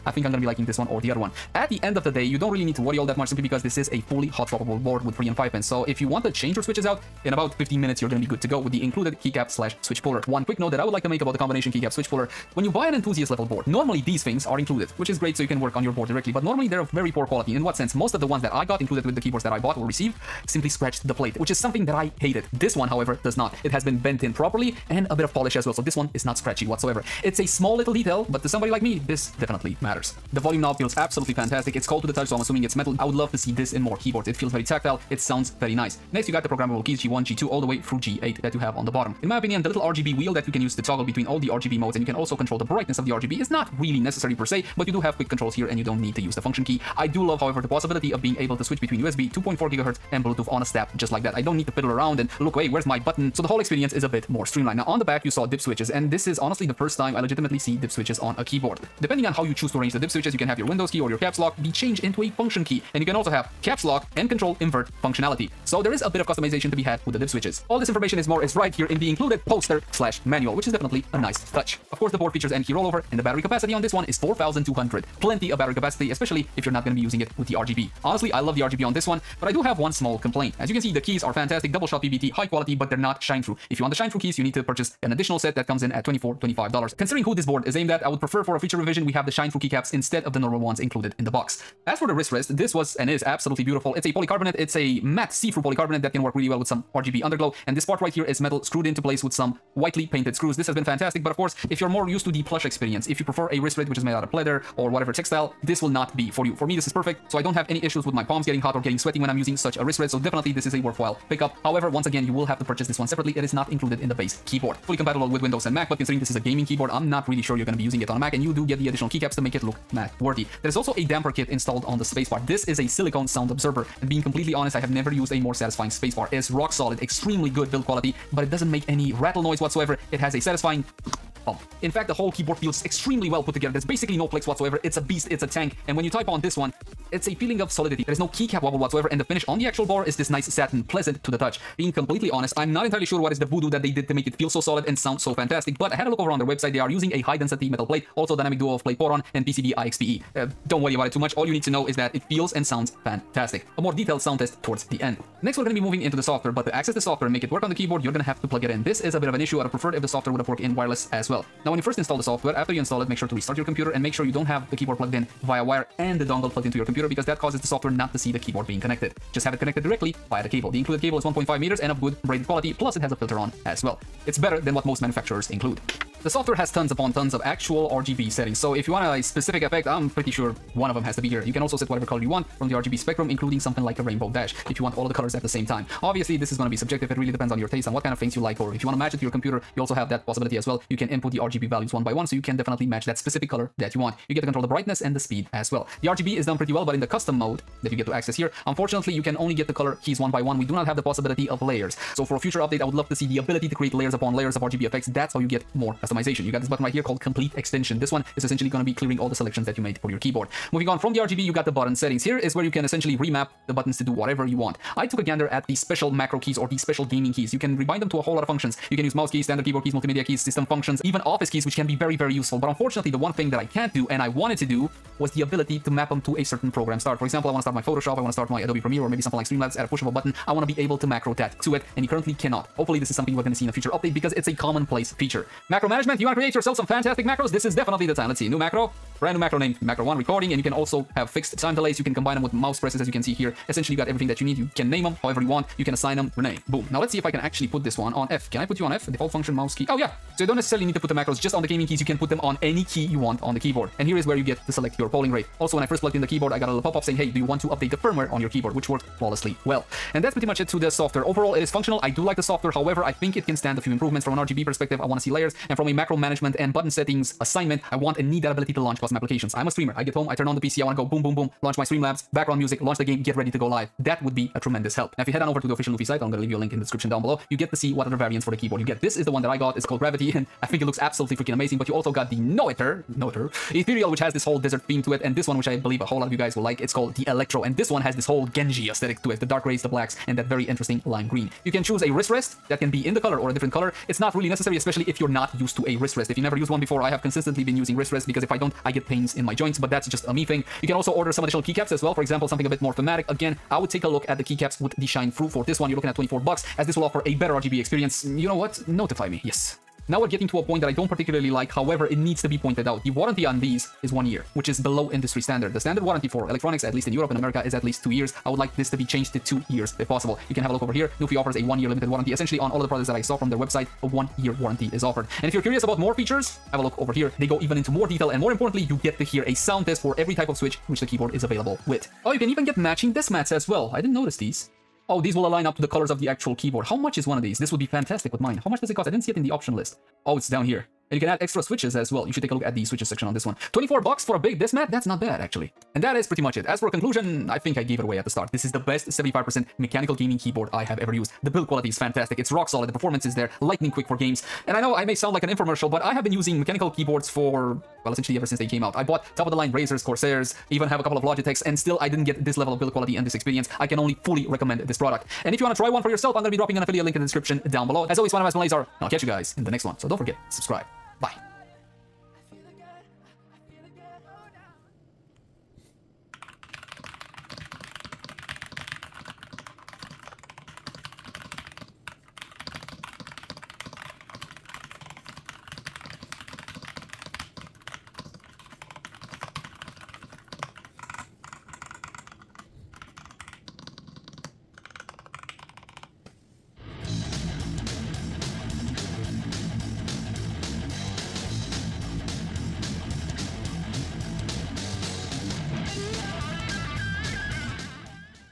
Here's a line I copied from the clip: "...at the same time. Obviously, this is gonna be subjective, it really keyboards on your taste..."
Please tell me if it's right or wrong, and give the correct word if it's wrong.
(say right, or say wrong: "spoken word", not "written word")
wrong: "depends", not "keyboards".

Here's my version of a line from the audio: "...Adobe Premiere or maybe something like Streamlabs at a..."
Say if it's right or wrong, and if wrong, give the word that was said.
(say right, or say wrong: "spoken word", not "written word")
right.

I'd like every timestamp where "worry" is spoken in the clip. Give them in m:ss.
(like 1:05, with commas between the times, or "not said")
0:02, 2:30.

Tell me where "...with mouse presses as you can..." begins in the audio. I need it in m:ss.
4:02.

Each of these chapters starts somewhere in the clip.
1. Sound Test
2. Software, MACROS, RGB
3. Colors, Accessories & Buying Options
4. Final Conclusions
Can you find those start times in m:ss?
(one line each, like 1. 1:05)
1. 6:11
2. 2:55
3. 4:35
4. 5:46.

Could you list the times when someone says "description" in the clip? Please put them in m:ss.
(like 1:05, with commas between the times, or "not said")
4:36, 6:07.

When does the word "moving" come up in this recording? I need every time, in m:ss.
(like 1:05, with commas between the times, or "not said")
2:35, 3:30.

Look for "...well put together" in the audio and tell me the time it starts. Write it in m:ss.
2:13.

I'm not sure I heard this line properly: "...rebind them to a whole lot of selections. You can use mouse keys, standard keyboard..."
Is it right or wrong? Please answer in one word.
wrong.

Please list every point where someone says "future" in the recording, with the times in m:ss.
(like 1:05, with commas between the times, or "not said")
1:28, 3:22, 3:53.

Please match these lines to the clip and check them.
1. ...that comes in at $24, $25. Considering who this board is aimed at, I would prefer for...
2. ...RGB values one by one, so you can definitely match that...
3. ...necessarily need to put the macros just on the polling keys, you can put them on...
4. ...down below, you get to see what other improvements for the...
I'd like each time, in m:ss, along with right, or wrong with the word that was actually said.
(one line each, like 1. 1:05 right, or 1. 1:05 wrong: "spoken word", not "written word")
1. 1:25 right
2. 3:11 right
3. 4:10 wrong: "gaming", not "polling"
4. 4:37 wrong: "variants", not "improvements".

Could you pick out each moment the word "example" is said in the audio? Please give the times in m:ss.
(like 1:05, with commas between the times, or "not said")
3:47, 5:02.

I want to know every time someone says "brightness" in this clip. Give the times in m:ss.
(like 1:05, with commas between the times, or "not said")
0:42, 3:14.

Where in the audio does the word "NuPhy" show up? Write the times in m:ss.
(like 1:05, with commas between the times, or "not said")
4:35, 5:21.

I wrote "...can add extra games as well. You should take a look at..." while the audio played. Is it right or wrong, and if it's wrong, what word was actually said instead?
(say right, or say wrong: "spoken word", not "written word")
wrong: "switches", not "games".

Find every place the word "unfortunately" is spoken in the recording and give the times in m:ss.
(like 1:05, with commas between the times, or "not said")
3:18, 3:42.